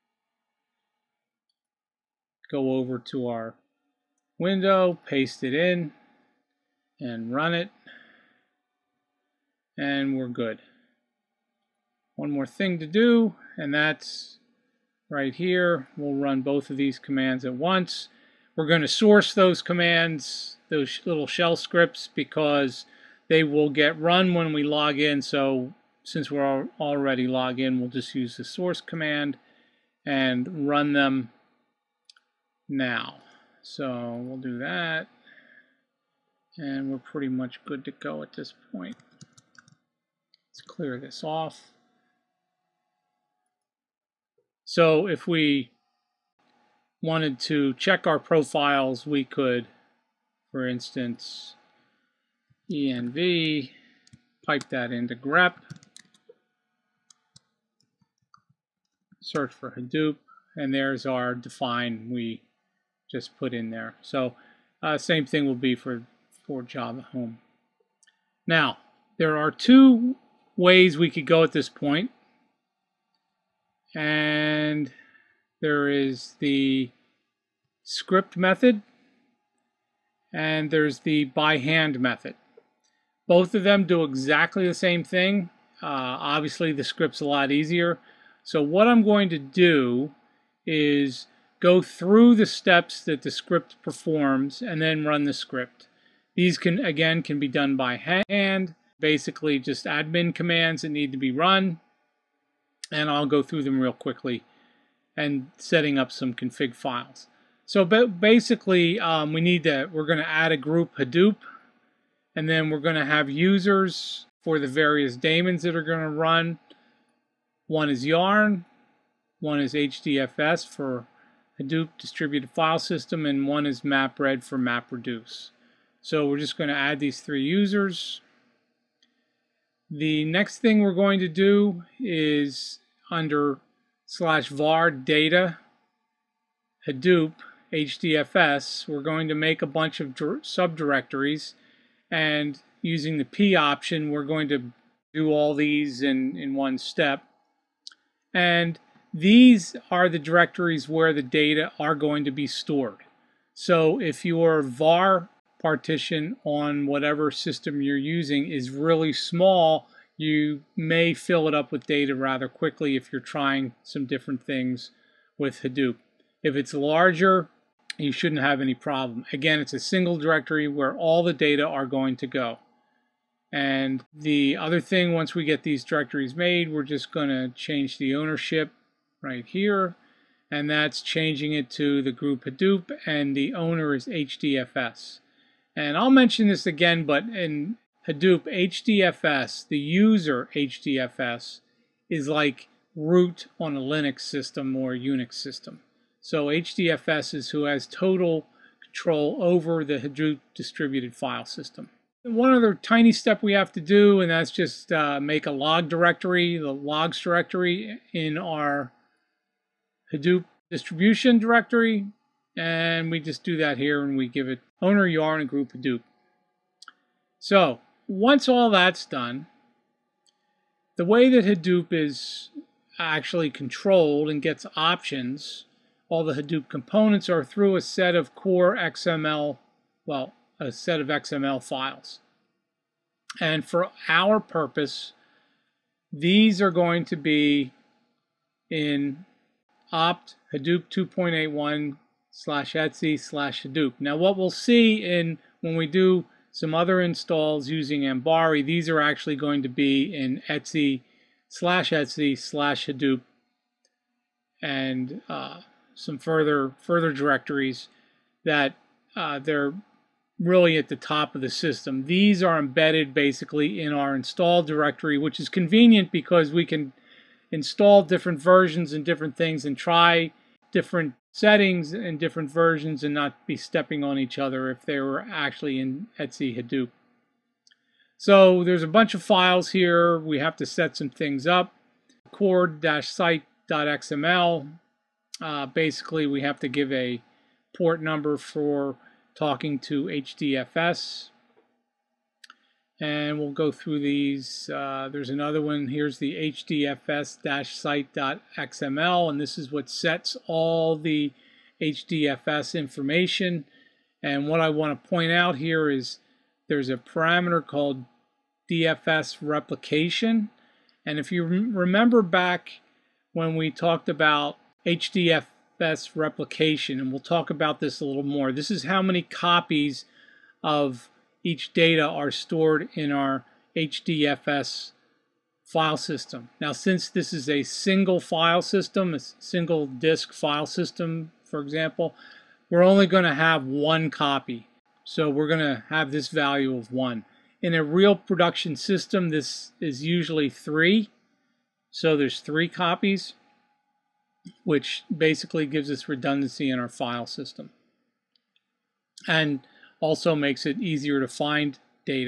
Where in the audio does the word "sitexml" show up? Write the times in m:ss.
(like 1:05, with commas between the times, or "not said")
4:42, 4:56.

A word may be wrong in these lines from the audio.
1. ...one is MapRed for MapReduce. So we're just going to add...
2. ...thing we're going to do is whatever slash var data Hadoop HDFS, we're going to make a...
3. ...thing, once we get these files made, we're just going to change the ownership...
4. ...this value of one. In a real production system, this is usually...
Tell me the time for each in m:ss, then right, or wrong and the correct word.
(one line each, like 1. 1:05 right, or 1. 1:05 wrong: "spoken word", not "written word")
1. 2:03 right
2. 2:10 wrong: "under", not "whatever"
3. 2:54 wrong: "directories", not "files"
4. 5:36 right.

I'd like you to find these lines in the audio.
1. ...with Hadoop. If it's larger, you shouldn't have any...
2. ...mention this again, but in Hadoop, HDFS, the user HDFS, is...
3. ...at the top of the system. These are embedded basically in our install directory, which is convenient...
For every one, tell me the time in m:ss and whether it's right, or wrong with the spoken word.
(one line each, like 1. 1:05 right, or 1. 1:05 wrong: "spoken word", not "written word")
1. 2:45 right
2. 3:06 right
3. 4:20 right.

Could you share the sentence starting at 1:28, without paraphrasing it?
So what I'm going to do is go through the steps that the script performs and then run the script.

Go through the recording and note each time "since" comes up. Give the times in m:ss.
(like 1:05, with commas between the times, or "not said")
0:26, 5:26.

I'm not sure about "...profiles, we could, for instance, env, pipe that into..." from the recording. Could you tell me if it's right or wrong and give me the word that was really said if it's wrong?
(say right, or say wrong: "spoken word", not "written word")
right.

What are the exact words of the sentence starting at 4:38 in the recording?
So there's a bunch of files here.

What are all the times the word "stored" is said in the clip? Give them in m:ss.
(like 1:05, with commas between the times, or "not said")
2:32, 5:22.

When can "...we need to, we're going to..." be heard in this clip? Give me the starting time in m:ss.
1:49.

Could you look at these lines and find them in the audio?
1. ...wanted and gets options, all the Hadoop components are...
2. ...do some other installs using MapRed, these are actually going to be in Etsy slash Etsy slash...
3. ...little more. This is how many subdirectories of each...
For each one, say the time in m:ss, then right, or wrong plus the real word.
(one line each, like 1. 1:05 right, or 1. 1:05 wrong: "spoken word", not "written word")
1. 3:43 wrong: "controlled", not "wanted"
2. 4:05 wrong: "Ambari", not "MapRed"
3. 5:18 wrong: "copies", not "subdirectories".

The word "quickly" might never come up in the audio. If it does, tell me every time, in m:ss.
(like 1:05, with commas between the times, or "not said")
1:43, 2:42.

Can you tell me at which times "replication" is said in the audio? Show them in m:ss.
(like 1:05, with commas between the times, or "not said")
5:09, 5:16.